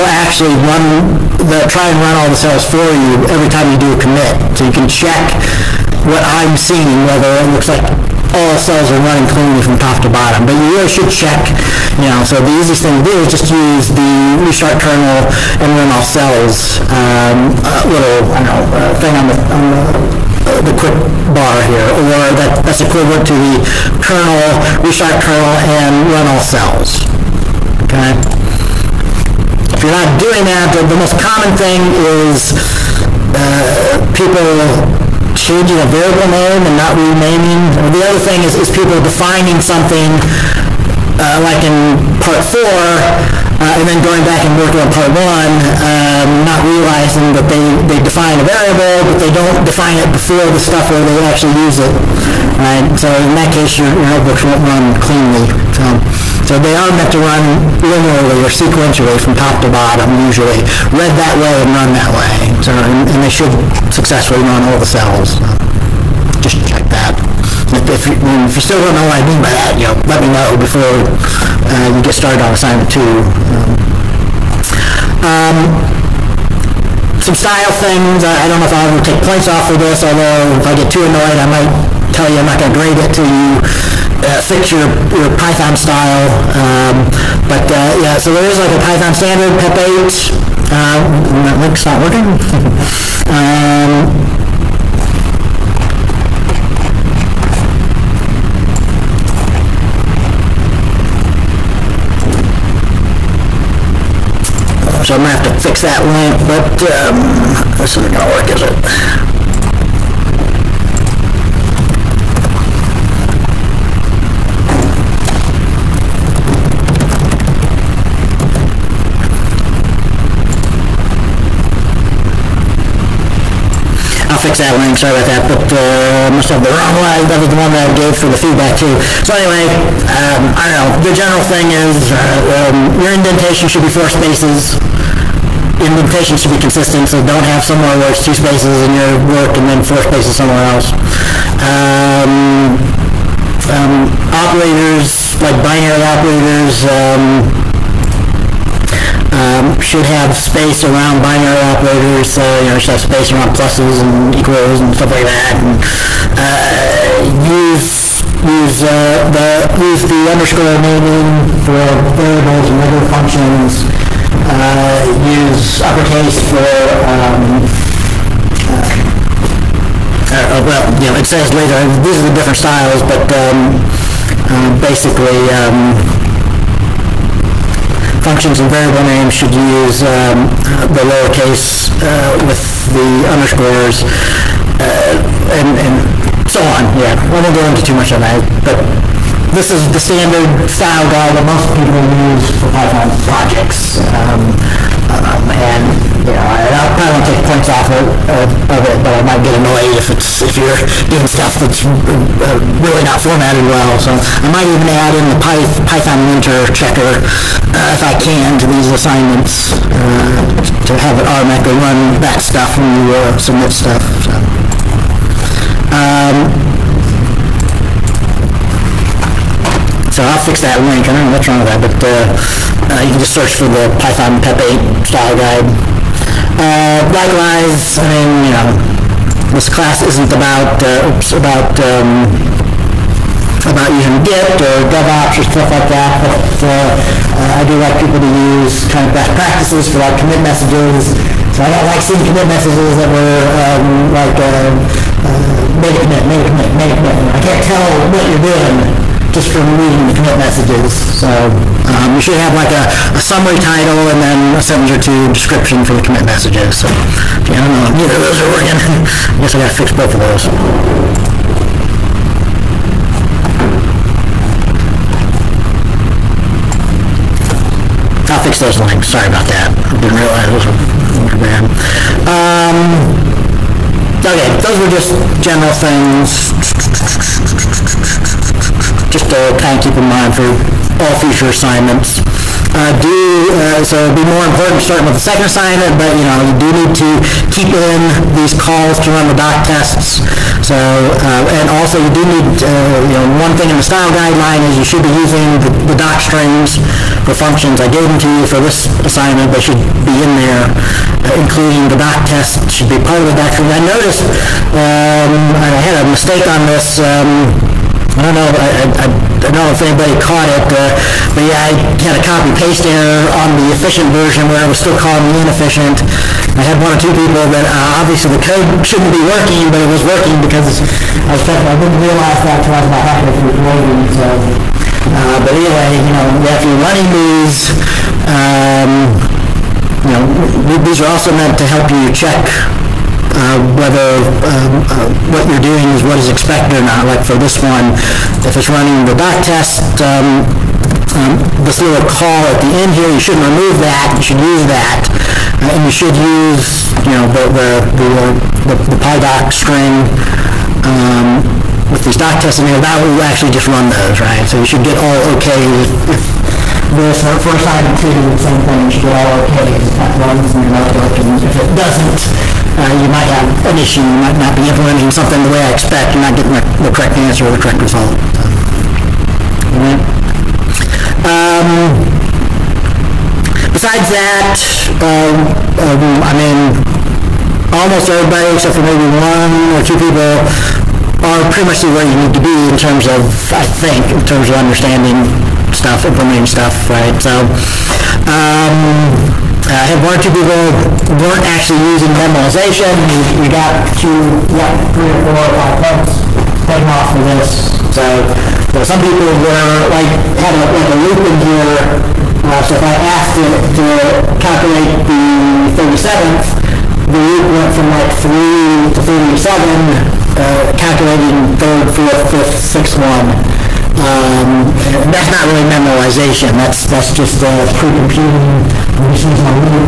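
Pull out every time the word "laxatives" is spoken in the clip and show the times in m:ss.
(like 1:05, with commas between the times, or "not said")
not said.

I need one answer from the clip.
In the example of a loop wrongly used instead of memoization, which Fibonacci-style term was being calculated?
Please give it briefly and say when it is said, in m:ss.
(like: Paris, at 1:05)
37th, at 6:45.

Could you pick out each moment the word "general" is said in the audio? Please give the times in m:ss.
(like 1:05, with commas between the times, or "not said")
2:11, 4:35.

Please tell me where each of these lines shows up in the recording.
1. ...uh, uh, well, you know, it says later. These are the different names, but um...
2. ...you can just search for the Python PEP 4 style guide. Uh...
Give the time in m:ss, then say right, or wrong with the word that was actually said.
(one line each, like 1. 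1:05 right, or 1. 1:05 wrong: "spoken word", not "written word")
1. 2:50 wrong: "styles", not "names"
2. 3:43 wrong: "8", not "4".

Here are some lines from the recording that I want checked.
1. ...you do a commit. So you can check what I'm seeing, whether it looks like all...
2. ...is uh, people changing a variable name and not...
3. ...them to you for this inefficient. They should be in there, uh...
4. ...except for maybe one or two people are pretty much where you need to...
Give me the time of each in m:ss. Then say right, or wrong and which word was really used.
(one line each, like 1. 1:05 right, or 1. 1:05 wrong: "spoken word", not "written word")
1. 0:03 right
2. 0:32 right
3. 4:58 wrong: "assignment", not "inefficient"
4. 6:18 right.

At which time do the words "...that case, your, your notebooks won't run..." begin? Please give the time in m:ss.
0:53.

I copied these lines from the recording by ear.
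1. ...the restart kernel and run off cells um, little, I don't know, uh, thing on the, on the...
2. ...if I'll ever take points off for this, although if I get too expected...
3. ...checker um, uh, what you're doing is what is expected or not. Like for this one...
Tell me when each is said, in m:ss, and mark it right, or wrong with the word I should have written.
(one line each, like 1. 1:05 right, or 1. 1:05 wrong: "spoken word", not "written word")
1. 0:13 right
2. 1:18 wrong: "annoyed", not "expected"
3. 5:33 wrong: "whether", not "checker".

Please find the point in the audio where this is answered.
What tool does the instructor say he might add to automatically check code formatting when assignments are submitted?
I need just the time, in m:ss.
3:25.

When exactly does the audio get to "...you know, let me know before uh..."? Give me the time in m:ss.
1:09.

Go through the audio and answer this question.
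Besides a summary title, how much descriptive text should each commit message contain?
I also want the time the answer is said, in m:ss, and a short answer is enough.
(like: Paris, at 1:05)
a sentence or two, at 4:14.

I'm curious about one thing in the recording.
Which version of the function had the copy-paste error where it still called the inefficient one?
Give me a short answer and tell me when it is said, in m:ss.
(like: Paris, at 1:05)
the efficient version, at 5:13.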